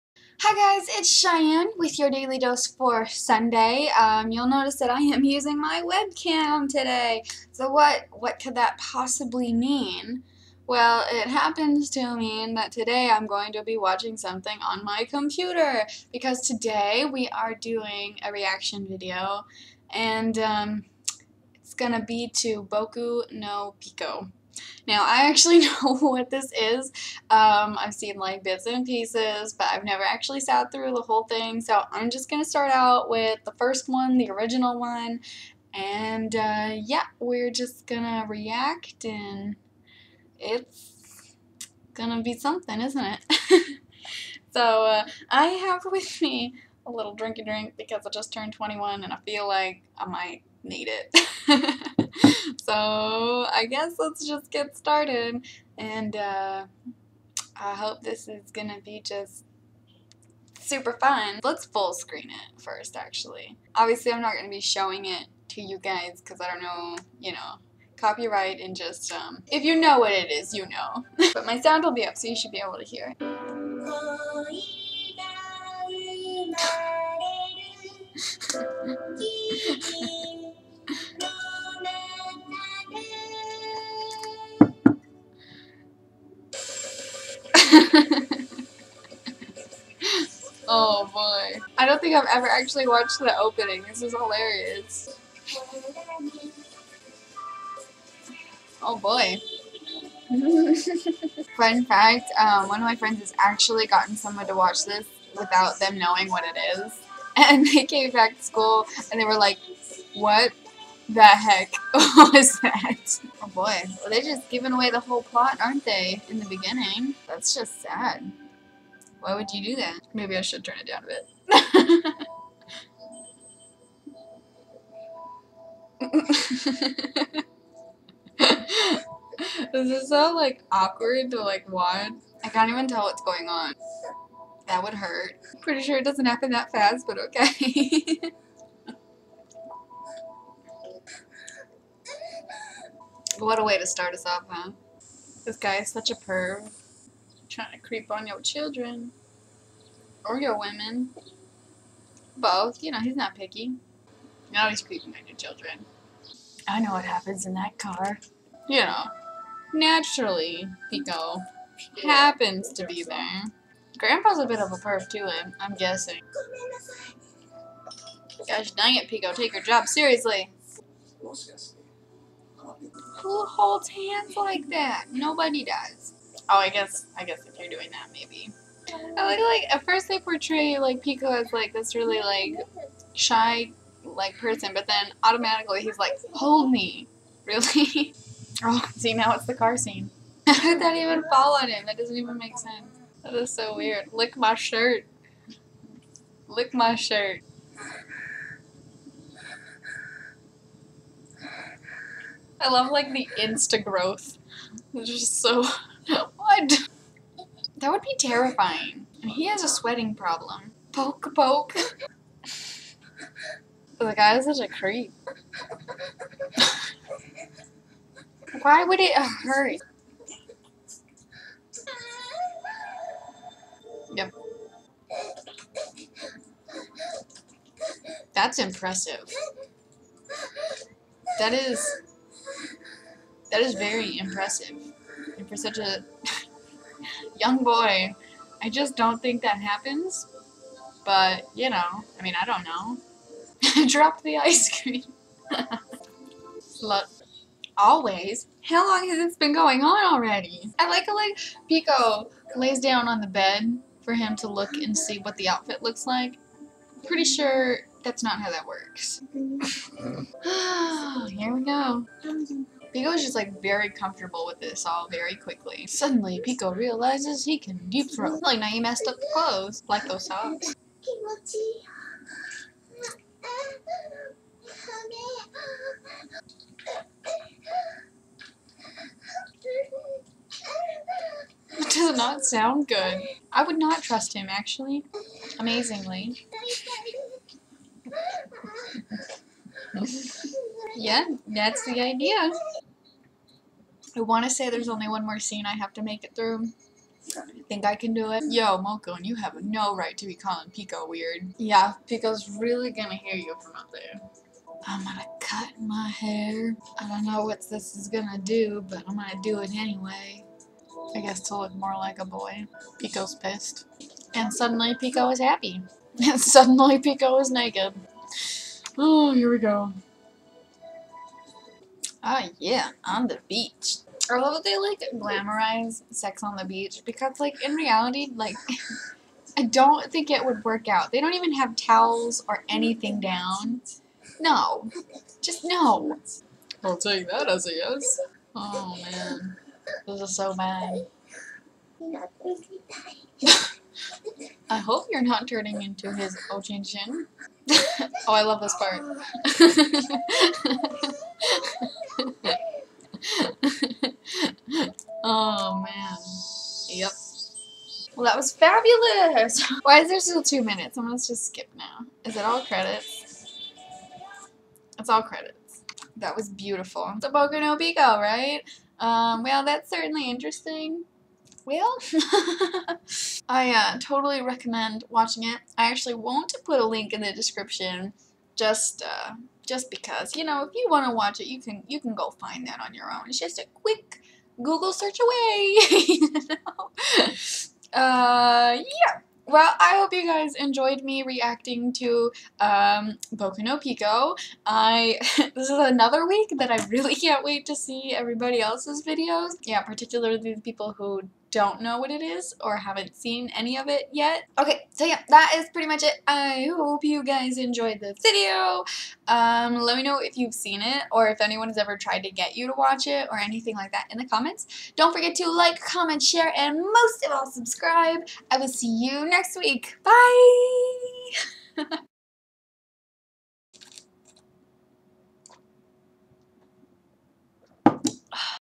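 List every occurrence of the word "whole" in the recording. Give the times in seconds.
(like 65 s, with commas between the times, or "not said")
31 s, 115 s.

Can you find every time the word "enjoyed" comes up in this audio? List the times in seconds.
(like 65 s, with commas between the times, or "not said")
390 s, 407 s.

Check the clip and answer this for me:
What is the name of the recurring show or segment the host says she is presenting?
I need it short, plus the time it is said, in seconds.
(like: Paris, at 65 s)
Daily Dose, at 2 s.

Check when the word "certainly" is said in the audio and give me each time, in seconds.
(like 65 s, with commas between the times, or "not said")
369 s.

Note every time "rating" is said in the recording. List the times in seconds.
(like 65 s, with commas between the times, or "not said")
not said.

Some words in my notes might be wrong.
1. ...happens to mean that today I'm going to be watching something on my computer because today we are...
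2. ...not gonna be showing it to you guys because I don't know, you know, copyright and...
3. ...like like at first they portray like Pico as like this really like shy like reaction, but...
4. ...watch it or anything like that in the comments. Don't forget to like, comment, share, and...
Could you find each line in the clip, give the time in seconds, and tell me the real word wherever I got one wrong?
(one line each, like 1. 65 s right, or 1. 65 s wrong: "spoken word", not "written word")
1. 11 s right
2. 64 s right
3. 179 s wrong: "person", not "reaction"
4. 412 s right.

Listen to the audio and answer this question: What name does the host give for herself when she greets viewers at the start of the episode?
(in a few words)
Cheyenne.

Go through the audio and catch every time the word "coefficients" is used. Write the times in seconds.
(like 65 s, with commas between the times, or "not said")
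not said.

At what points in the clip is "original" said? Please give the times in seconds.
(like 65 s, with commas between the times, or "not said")
34 s.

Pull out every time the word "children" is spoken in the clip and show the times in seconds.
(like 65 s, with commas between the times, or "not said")
148 s, 155 s.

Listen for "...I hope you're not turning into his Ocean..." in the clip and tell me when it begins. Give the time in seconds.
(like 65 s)
344 s.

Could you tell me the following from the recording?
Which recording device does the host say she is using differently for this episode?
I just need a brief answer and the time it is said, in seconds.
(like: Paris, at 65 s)
Webcam, at 5 s.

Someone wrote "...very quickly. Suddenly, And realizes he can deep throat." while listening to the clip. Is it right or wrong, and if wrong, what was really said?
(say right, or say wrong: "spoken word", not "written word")
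wrong: "Pico", not "And".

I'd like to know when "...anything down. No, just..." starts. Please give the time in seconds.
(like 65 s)
332 s.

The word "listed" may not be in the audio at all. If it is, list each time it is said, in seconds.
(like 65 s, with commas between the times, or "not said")
not said.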